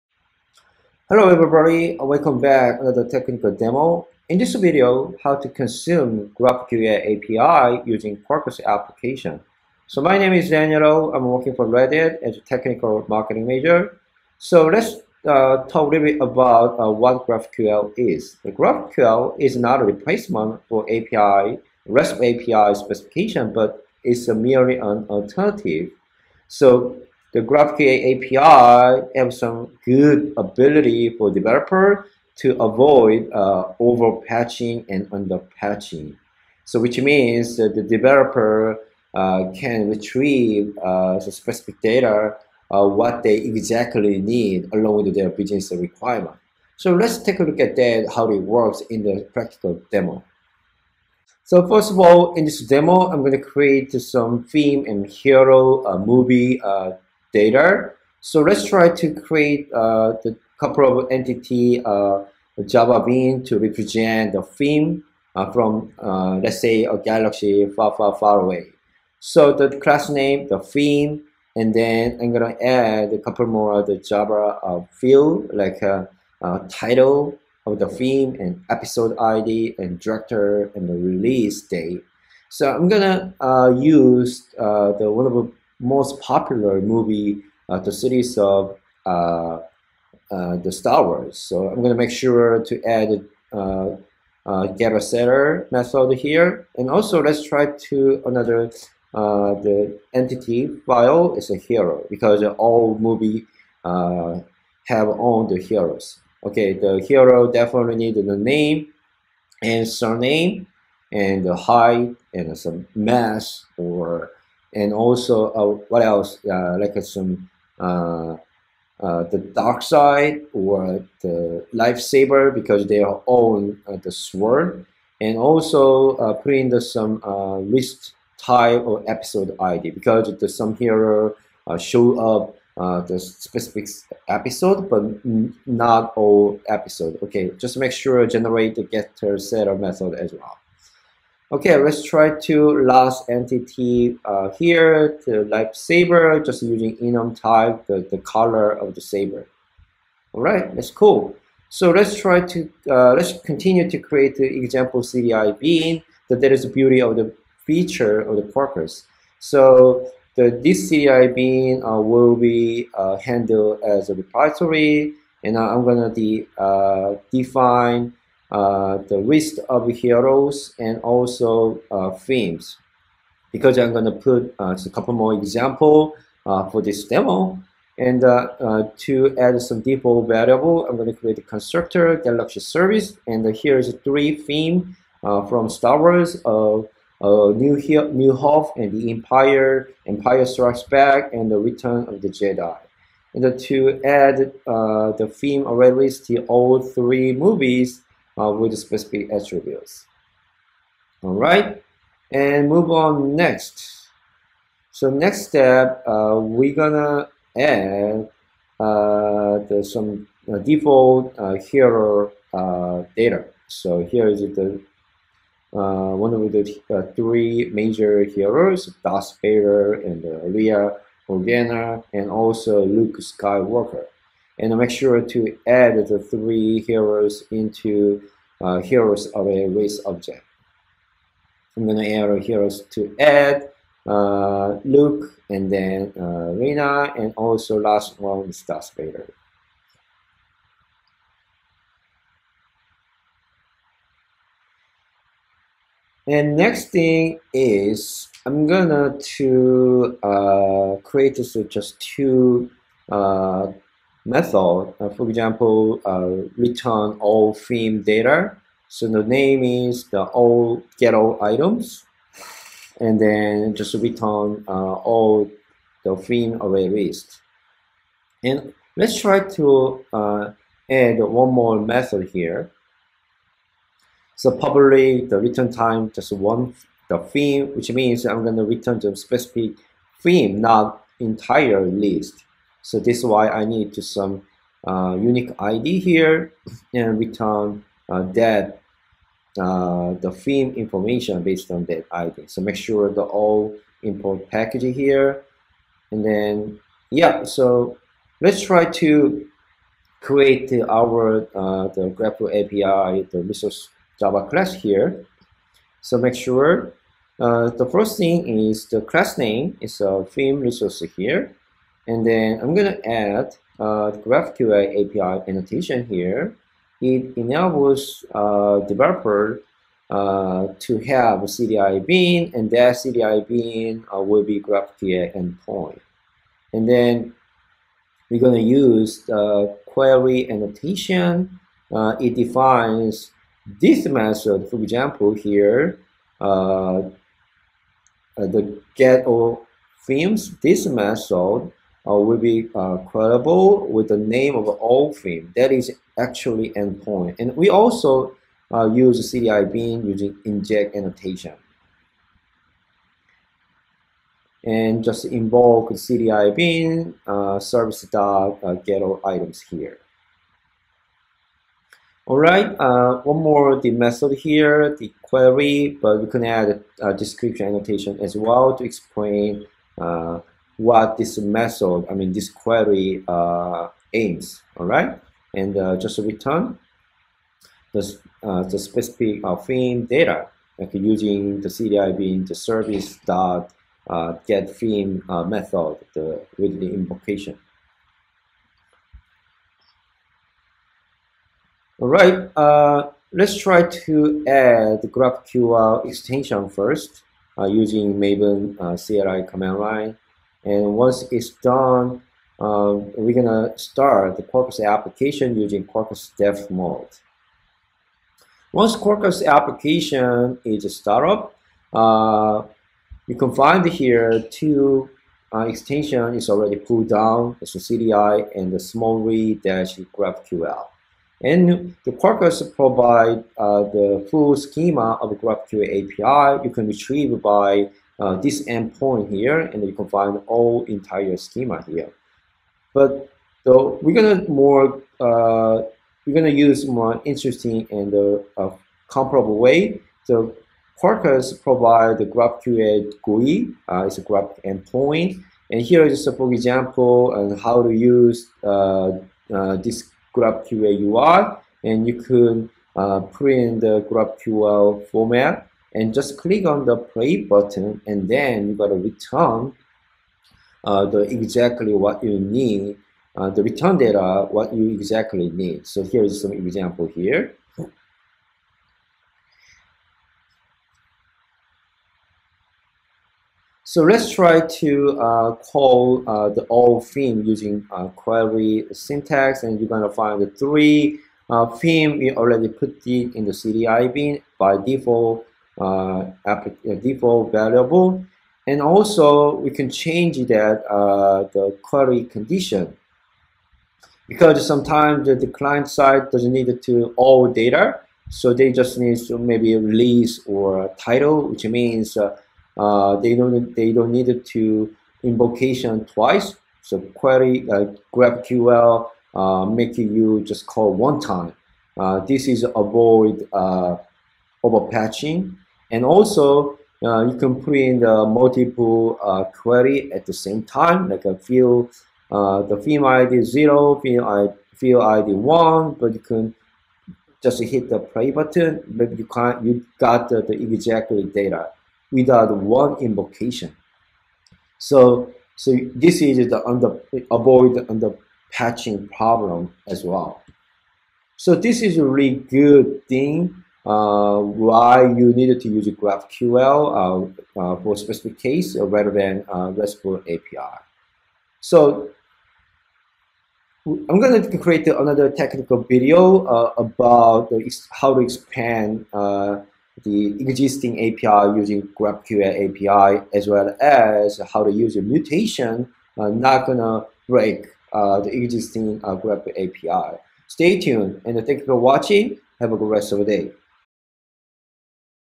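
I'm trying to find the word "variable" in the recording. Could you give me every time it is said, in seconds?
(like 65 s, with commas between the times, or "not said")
180 s, 487 s.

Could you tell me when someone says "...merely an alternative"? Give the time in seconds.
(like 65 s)
24 s.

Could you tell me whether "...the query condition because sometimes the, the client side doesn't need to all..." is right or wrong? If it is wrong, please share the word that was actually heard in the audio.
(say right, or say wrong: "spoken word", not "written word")
right.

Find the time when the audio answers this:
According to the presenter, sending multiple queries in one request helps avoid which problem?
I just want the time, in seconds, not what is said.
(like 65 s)
537 s.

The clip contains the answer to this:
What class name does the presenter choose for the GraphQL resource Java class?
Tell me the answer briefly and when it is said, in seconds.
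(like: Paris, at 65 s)
theme resource, at 310 s.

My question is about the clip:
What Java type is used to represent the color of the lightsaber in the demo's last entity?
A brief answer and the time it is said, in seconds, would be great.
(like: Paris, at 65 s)
enum, at 146 s.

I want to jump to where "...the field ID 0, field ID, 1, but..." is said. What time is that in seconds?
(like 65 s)
522 s.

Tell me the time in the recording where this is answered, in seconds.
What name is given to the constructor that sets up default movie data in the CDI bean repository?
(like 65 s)
182 s.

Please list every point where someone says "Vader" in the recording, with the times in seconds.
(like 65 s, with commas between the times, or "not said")
219 s, 238 s.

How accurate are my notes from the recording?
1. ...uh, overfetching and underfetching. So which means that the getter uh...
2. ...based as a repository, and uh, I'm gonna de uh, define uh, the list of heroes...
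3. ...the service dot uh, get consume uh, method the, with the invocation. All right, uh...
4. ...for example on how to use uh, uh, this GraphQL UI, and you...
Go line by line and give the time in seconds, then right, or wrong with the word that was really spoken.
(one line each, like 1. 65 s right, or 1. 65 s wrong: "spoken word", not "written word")
1. 33 s wrong: "developer", not "getter"
2. 163 s wrong: "handled", not "based"
3. 382 s wrong: "theme", not "consume"
4. 446 s right.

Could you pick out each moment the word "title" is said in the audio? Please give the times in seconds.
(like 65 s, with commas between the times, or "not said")
76 s, 500 s.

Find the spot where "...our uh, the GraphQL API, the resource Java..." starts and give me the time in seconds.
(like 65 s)
300 s.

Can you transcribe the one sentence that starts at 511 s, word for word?
Uh, this is avoid uh, over fetching.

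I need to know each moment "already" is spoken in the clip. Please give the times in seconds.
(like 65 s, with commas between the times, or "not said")
195 s, 416 s, 482 s.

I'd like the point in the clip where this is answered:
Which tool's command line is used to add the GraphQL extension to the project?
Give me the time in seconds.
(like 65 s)
398 s.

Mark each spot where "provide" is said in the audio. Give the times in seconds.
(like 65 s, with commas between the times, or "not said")
422 s, 441 s.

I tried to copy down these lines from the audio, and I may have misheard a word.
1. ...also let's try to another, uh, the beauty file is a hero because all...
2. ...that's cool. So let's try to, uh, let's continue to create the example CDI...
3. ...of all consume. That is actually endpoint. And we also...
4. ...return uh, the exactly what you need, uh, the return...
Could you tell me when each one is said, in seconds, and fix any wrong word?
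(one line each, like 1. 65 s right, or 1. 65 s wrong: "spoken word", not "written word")
1. 96 s wrong: "entity", not "beauty"
2. 150 s right
3. 344 s wrong: "theme", not "consume"
4. 458 s right.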